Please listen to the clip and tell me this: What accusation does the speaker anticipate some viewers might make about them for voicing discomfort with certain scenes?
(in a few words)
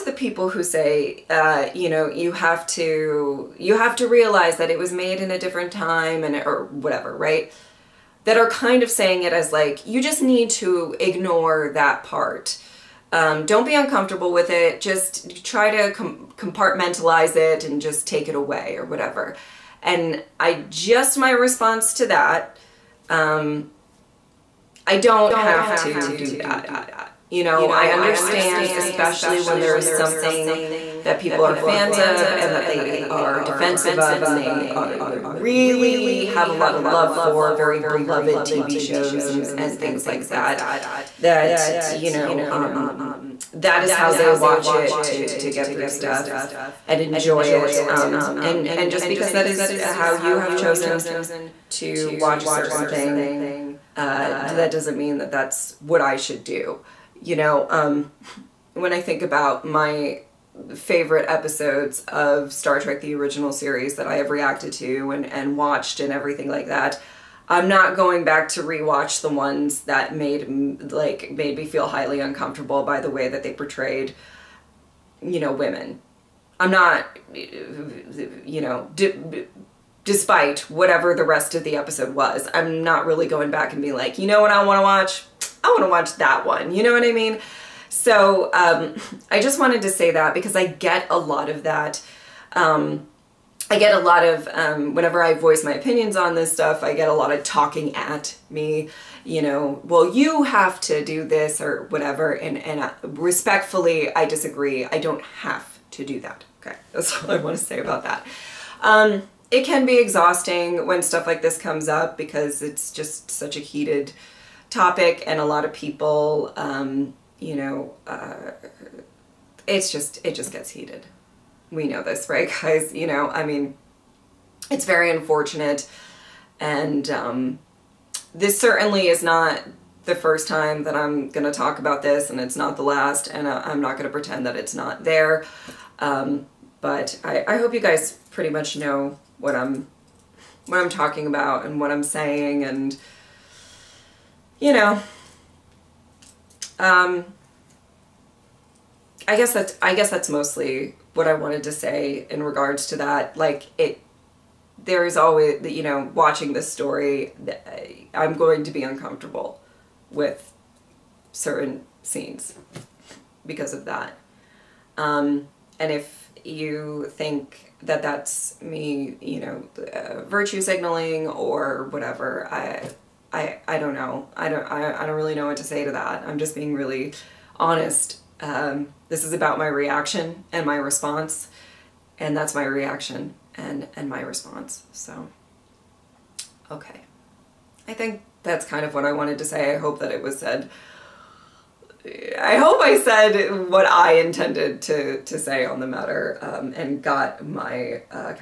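virtue signaling.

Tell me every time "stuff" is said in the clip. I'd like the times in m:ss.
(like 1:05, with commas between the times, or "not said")
0:45, 1:36, 1:51.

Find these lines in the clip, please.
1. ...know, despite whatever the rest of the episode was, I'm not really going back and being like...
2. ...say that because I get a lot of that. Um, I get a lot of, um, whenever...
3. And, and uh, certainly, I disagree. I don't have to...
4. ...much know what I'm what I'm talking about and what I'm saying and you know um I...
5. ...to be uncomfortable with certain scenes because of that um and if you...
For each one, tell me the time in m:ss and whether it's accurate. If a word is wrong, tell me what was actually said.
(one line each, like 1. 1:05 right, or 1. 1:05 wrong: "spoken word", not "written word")
1. 1:18 right
2. 1:29 right
3. 1:42 wrong: "respectfully", not "certainly"
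4. 2:18 right
5. 2:38 right.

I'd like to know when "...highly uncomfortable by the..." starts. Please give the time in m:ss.
1:11.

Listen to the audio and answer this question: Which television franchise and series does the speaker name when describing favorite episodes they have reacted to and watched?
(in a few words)
Star Trek the original series.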